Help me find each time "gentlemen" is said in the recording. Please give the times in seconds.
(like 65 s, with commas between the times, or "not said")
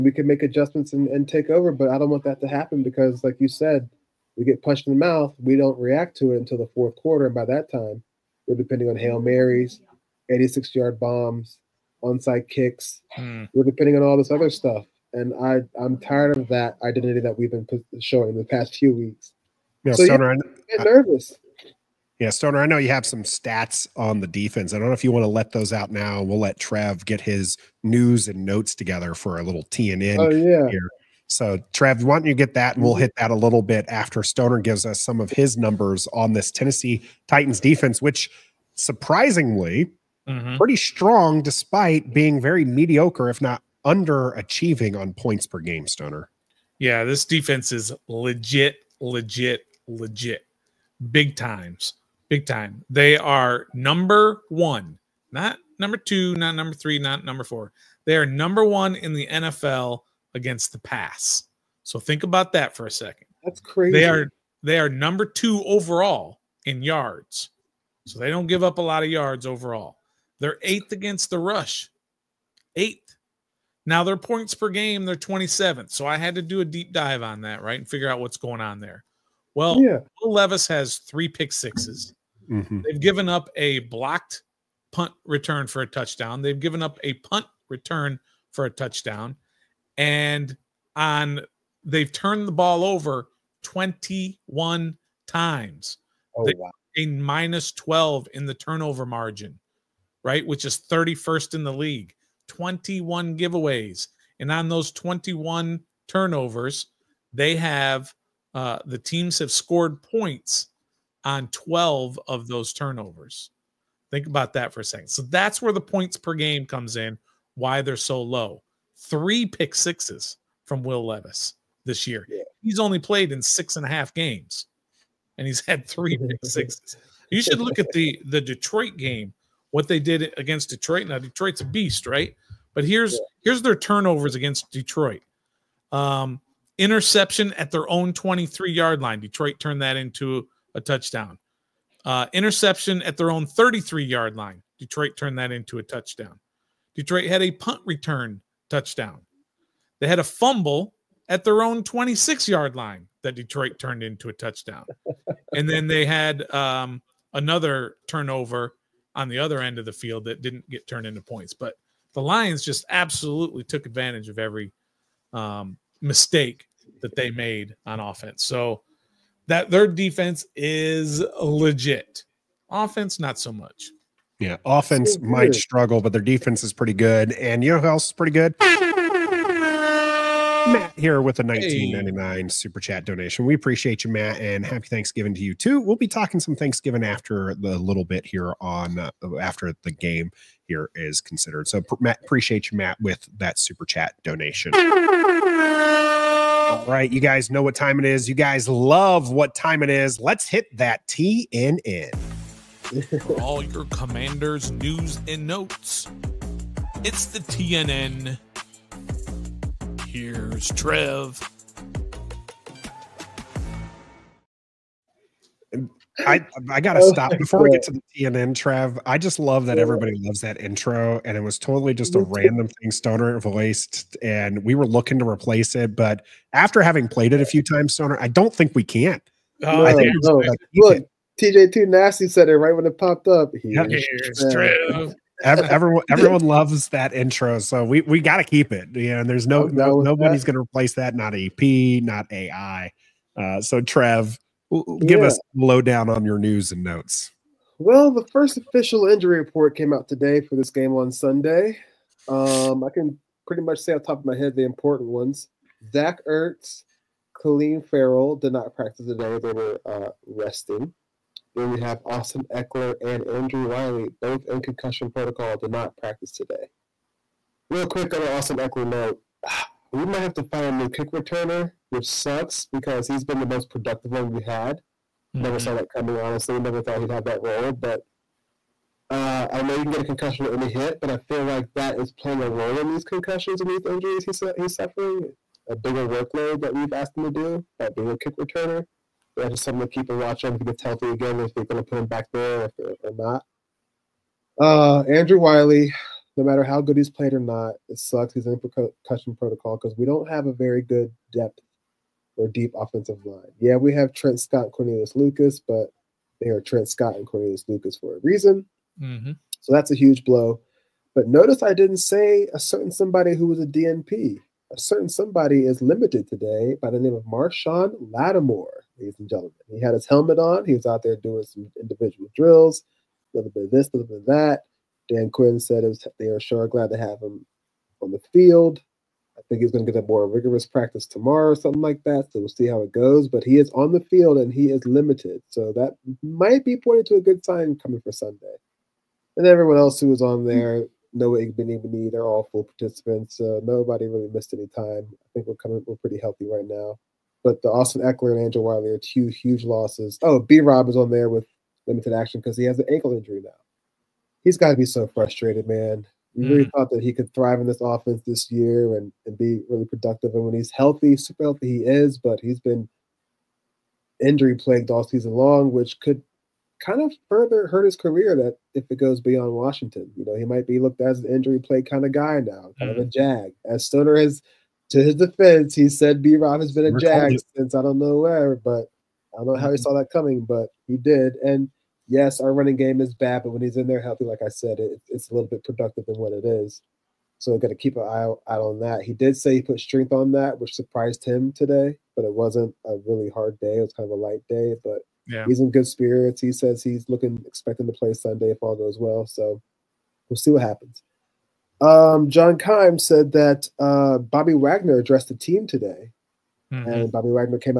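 319 s.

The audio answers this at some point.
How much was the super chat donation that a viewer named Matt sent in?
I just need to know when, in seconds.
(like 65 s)
181 s.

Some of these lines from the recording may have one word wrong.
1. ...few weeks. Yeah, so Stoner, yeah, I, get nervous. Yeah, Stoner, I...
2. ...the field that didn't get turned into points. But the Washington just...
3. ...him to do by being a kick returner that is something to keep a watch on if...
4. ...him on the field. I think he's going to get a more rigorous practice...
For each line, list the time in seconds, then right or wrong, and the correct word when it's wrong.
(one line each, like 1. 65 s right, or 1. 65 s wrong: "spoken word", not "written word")
1. 18 s right
2. 159 s wrong: "Lions", not "Washington"
3. 287 s right
4. 327 s right.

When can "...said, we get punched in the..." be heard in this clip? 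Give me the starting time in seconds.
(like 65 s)
3 s.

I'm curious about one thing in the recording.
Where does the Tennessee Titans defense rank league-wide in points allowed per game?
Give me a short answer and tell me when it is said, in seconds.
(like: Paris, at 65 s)
27th, at 75 s.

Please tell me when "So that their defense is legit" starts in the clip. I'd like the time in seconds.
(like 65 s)
168 s.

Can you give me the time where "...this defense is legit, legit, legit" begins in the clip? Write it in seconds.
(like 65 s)
47 s.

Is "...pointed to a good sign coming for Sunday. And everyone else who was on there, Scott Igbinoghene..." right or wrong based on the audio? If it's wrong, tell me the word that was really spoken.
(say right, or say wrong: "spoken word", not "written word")
wrong: "Noah", not "Scott".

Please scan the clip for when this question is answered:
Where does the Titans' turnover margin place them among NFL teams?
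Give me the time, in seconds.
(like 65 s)
100 s.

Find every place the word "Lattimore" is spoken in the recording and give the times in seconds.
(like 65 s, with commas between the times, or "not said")
318 s.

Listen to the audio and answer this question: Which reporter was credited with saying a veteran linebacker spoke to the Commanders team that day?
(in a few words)
John Kimes.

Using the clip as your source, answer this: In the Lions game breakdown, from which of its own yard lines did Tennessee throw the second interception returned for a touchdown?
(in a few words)
33.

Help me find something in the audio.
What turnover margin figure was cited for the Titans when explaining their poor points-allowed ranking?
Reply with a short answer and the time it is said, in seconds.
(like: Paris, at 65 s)
-12, at 97 s.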